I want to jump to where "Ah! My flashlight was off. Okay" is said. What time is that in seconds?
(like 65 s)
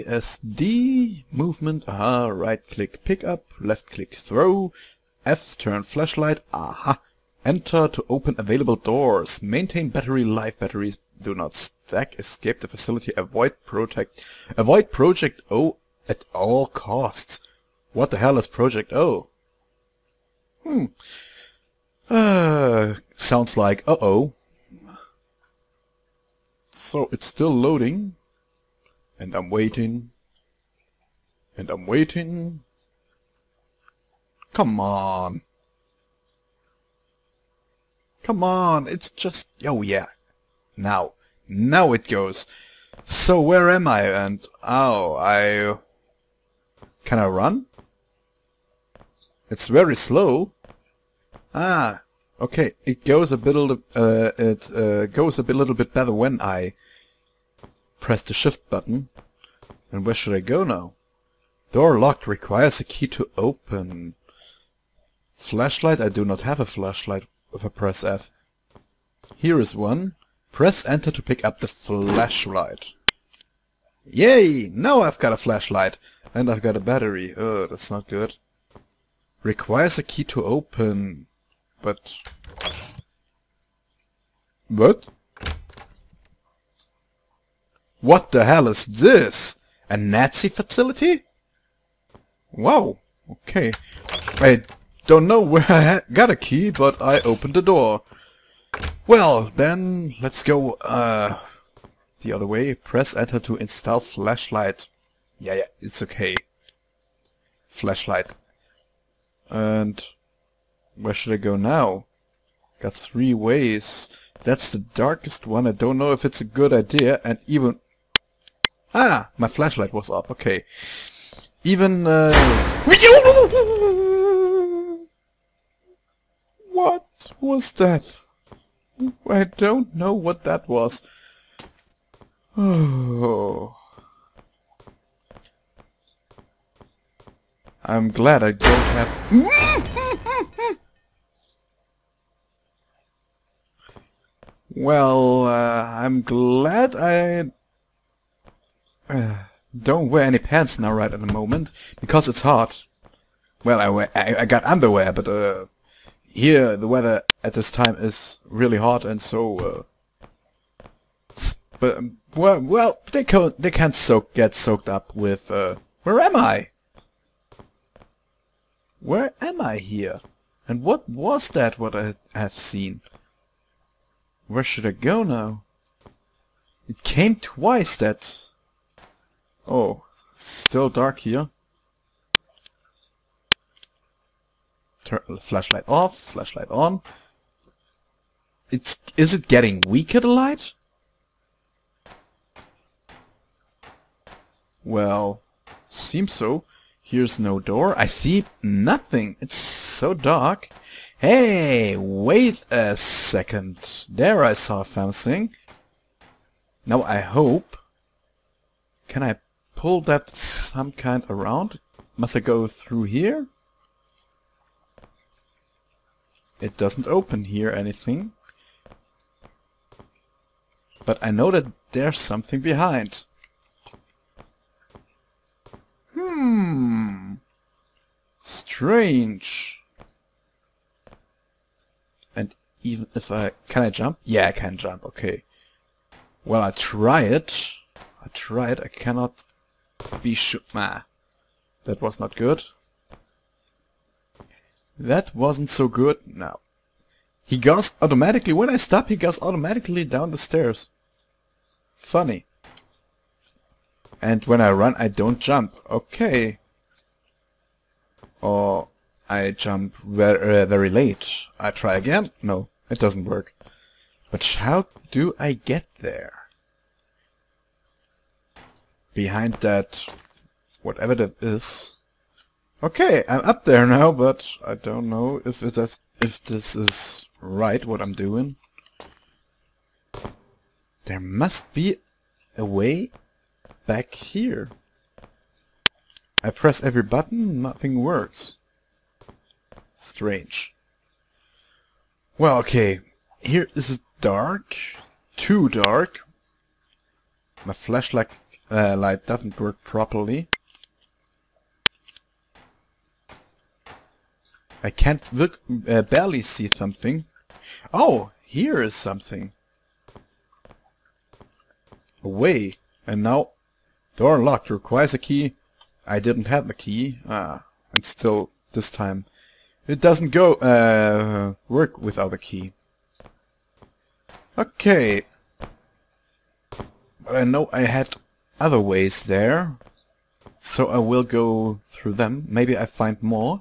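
118 s.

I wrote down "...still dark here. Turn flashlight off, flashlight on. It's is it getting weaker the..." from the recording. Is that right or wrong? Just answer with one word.
right.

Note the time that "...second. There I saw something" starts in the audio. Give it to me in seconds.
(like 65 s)
202 s.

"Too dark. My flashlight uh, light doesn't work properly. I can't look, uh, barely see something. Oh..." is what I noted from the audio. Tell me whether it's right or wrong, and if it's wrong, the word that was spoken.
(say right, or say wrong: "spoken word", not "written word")
right.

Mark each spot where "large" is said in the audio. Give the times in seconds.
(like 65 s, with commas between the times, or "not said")
not said.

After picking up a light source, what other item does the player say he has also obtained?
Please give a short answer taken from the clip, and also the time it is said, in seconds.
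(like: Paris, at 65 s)
A battery, at 76 s.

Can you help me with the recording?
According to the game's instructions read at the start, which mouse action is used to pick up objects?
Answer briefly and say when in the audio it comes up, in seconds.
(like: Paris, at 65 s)
Right click, at 2 s.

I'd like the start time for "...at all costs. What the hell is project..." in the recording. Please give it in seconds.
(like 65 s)
16 s.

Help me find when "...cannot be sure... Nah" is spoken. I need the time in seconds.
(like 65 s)
238 s.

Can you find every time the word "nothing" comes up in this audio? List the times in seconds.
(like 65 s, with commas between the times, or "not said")
198 s, 287 s.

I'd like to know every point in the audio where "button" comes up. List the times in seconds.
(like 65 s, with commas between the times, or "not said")
58 s, 287 s.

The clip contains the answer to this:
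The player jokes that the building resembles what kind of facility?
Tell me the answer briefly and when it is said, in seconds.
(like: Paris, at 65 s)
A Nazi facility, at 89 s.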